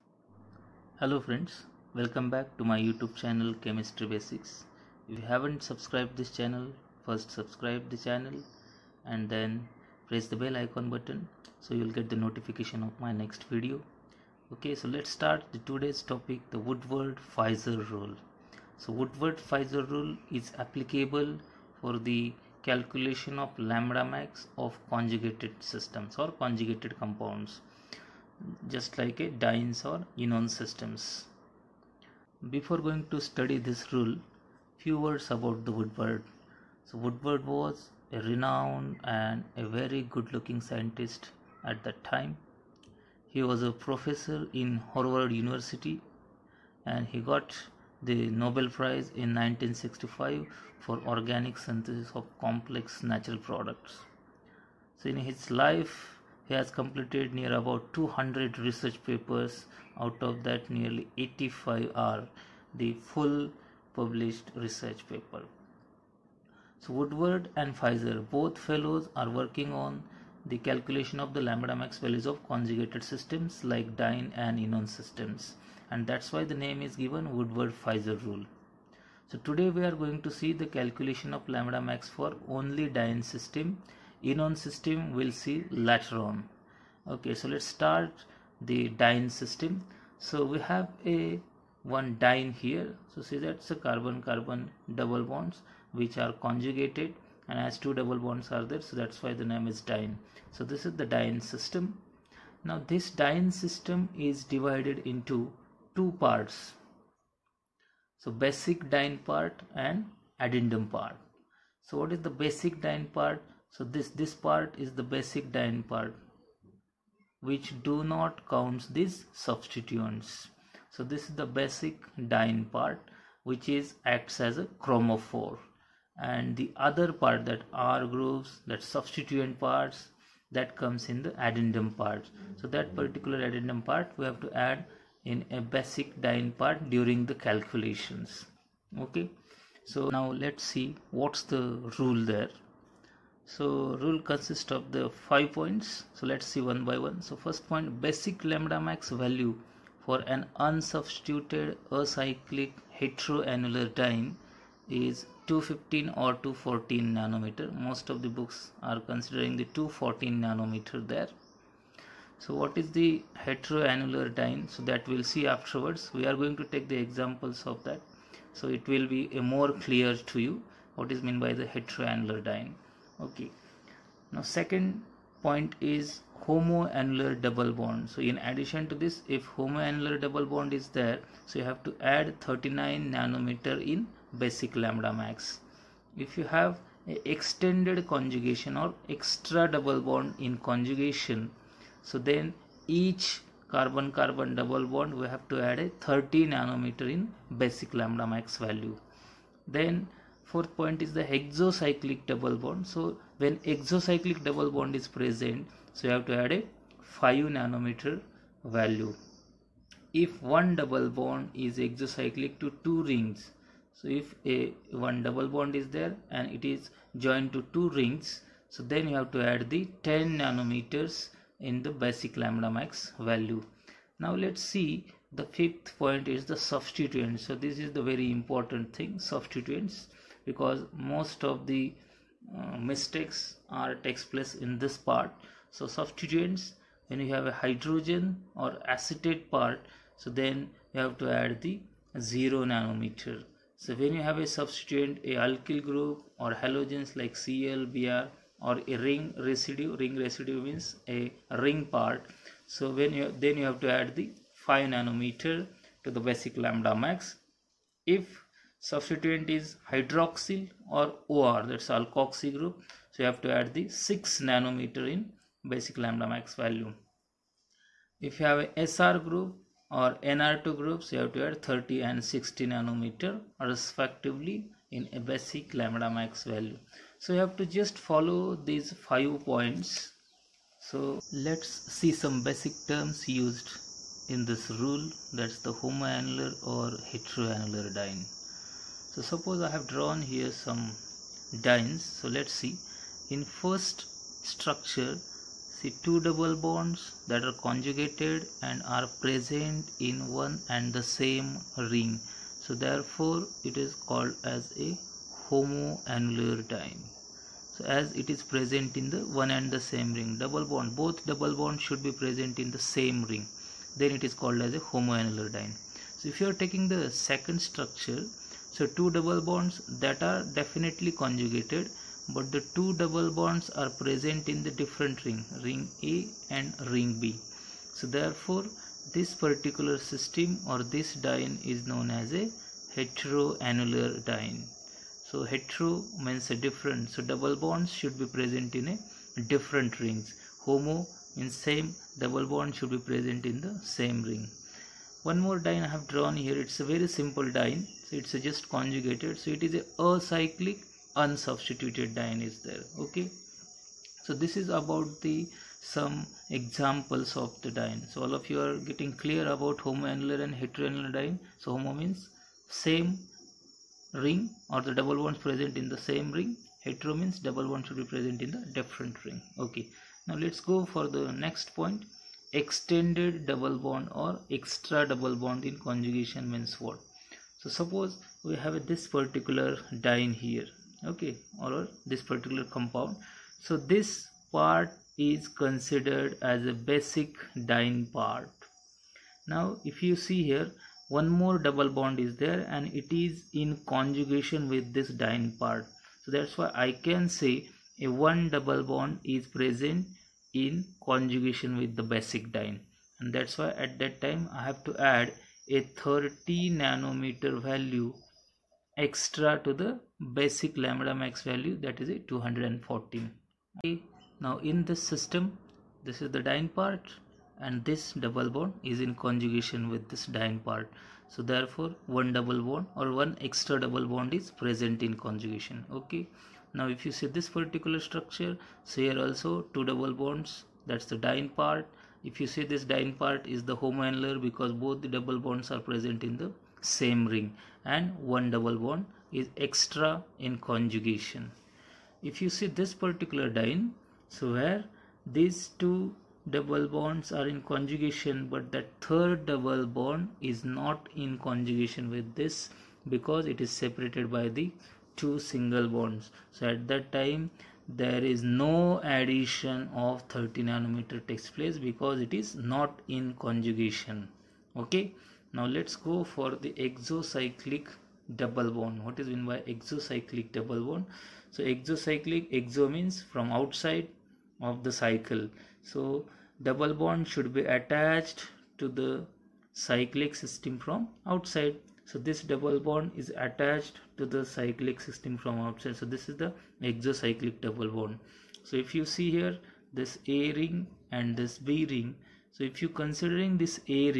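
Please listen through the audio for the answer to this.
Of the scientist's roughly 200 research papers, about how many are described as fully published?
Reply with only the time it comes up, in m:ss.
1:01.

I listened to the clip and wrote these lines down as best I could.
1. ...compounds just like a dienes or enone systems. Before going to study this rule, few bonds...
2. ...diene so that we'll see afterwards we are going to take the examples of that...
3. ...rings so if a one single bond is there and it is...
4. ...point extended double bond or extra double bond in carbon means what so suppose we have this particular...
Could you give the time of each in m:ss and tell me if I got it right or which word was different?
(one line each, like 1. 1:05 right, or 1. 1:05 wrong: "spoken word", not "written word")
1. 0:26 wrong: "words", not "bonds"
2. 2:44 right
3. 3:33 wrong: "double", not "single"
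4. 6:11 wrong: "conjugation", not "carbon".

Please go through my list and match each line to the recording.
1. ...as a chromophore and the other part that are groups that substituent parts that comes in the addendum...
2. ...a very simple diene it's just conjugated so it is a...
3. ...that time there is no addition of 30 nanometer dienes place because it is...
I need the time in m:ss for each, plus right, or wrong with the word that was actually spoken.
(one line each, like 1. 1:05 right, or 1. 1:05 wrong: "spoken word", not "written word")
1. 2:04 right
2. 5:46 right
3. 7:36 wrong: "takes", not "dienes".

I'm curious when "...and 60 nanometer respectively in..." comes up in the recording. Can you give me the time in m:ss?
4:32.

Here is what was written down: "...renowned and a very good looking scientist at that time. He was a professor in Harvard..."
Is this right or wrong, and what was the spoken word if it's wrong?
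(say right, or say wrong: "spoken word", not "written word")
right.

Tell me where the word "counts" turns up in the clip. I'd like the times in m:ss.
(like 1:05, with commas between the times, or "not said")
1:58.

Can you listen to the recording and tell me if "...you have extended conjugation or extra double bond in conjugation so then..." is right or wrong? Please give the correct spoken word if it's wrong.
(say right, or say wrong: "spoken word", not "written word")
right.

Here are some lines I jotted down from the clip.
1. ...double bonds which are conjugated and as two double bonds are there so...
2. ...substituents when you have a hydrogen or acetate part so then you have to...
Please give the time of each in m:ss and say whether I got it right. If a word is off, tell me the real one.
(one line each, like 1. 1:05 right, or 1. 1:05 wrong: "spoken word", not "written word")
1. 1:34 right
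2. 3:55 right.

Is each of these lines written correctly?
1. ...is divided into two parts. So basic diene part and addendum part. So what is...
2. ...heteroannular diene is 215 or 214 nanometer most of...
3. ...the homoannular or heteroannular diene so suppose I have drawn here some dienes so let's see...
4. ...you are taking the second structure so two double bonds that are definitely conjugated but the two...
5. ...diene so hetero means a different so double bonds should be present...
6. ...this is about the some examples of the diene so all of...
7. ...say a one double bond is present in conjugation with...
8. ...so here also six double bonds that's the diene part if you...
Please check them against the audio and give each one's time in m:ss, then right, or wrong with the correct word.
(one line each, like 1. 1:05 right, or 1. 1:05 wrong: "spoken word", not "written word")
1. 1:44 right
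2. 2:33 right
3. 4:45 right
4. 5:16 right
5. 5:34 right
6. 5:54 right
7. 6:37 right
8. 7:08 wrong: "two", not "six".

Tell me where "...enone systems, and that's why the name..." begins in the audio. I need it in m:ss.
1:14.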